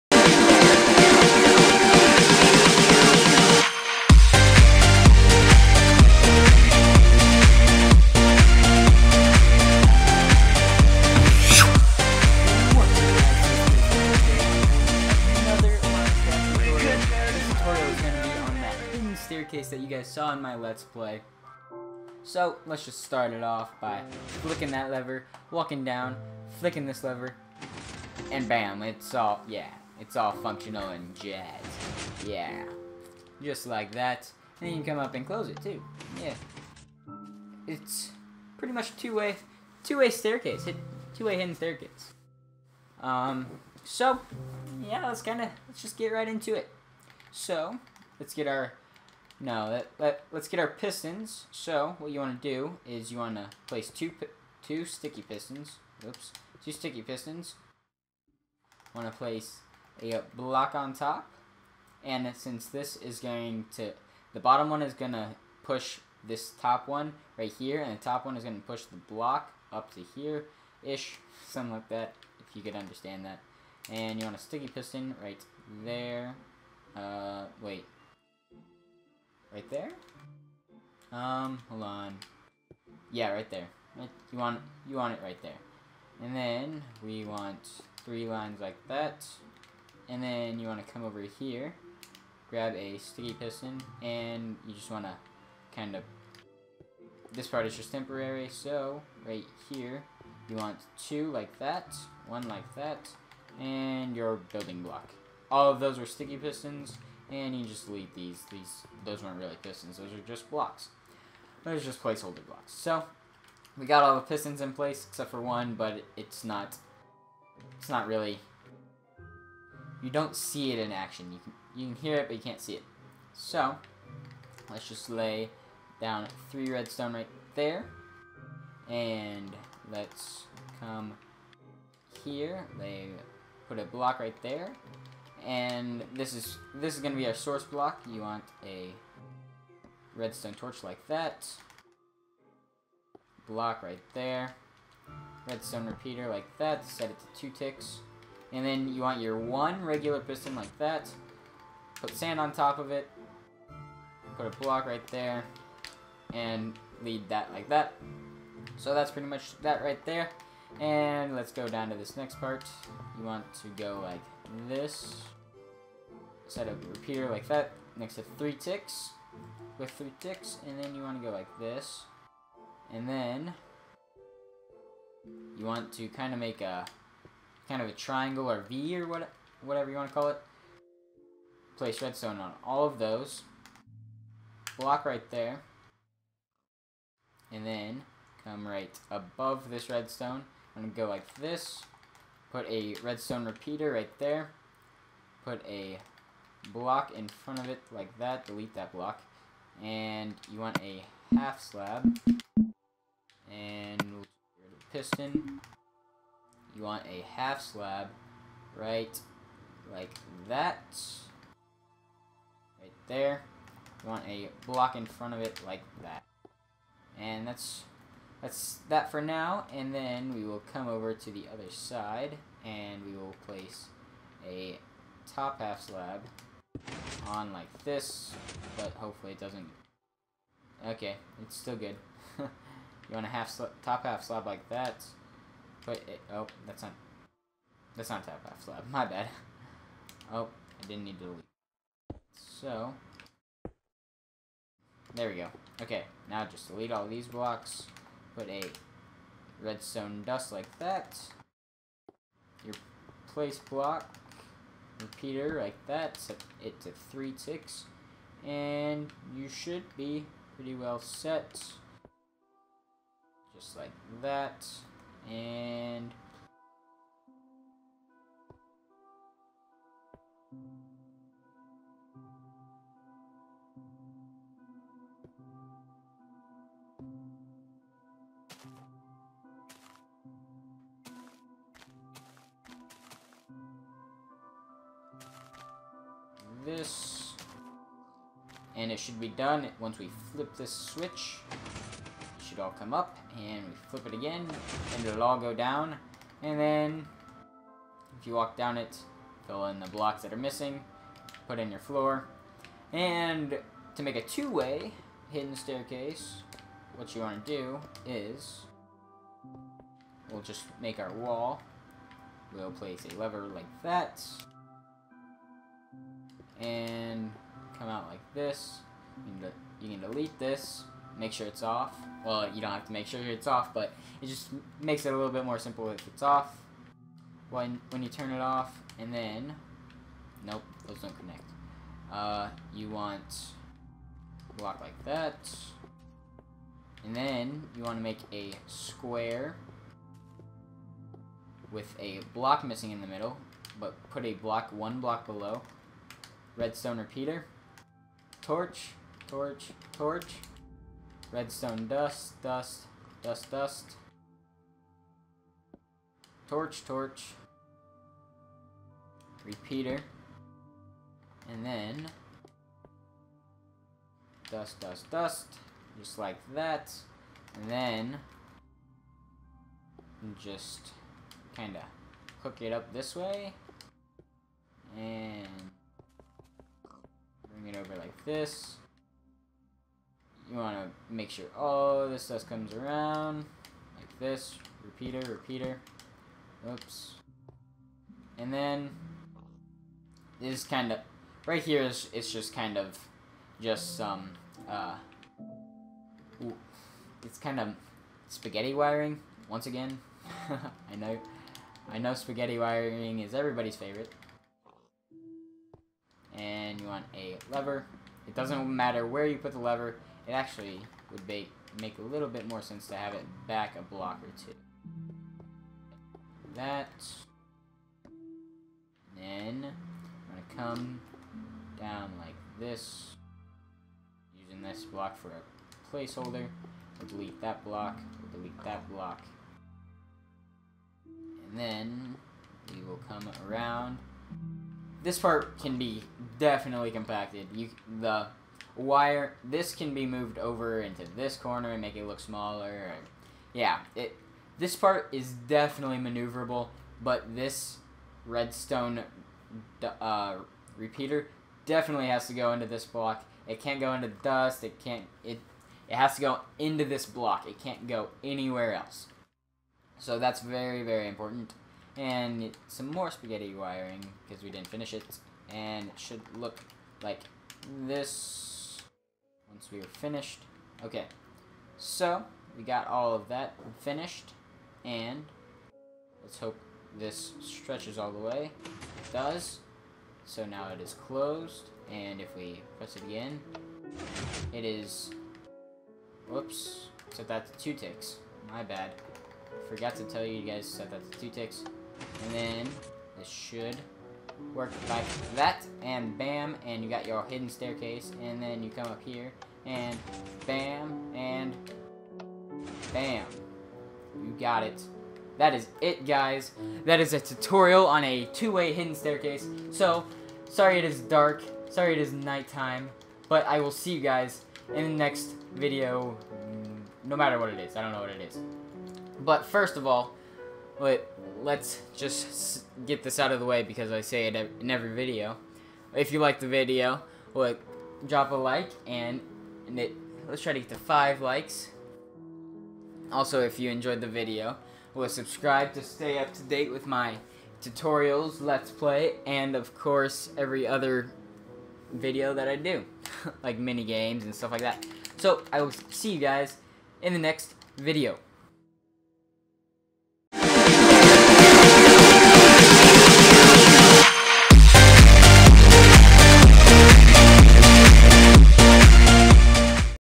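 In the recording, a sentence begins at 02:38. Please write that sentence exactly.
So that's pretty much that right there.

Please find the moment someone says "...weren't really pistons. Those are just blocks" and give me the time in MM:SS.
01:49.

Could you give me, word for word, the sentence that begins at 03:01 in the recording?
Place redstone on all of those.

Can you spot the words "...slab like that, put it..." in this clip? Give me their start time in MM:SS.
03:54.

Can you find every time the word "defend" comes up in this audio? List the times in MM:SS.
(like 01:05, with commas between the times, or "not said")
not said.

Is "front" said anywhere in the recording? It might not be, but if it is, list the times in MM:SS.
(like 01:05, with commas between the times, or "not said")
03:17, 03:35.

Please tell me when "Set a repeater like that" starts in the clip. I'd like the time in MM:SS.
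02:46.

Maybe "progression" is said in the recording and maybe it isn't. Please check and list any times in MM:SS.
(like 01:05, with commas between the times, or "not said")
not said.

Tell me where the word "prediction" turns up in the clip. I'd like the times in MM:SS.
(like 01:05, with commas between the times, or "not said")
not said.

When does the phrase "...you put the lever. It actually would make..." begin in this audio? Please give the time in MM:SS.
06:49.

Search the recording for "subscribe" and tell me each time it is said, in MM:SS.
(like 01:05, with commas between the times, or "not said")
08:55.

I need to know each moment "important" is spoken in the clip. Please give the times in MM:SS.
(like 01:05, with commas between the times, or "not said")
07:41.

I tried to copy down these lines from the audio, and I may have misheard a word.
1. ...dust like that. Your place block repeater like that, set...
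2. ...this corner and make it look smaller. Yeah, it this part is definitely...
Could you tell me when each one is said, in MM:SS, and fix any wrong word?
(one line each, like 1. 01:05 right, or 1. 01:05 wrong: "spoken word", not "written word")
1. 04:10 right
2. 07:21 right.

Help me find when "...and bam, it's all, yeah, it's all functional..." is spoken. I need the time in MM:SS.
00:28.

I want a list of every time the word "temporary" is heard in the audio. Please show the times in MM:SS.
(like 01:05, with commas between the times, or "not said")
01:37.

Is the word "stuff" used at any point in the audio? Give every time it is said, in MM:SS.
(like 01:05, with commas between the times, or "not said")
06:22, 09:04.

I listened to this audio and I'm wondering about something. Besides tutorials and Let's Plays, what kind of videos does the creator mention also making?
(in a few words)
Mini games.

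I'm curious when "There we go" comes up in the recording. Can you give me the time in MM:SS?
04:05.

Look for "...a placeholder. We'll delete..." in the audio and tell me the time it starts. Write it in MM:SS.
07:05.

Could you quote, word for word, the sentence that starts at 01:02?
And since this is going to...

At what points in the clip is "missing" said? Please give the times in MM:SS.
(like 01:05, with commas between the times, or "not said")
05:00, 05:42.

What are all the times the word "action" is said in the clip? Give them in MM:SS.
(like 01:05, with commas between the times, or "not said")
02:00.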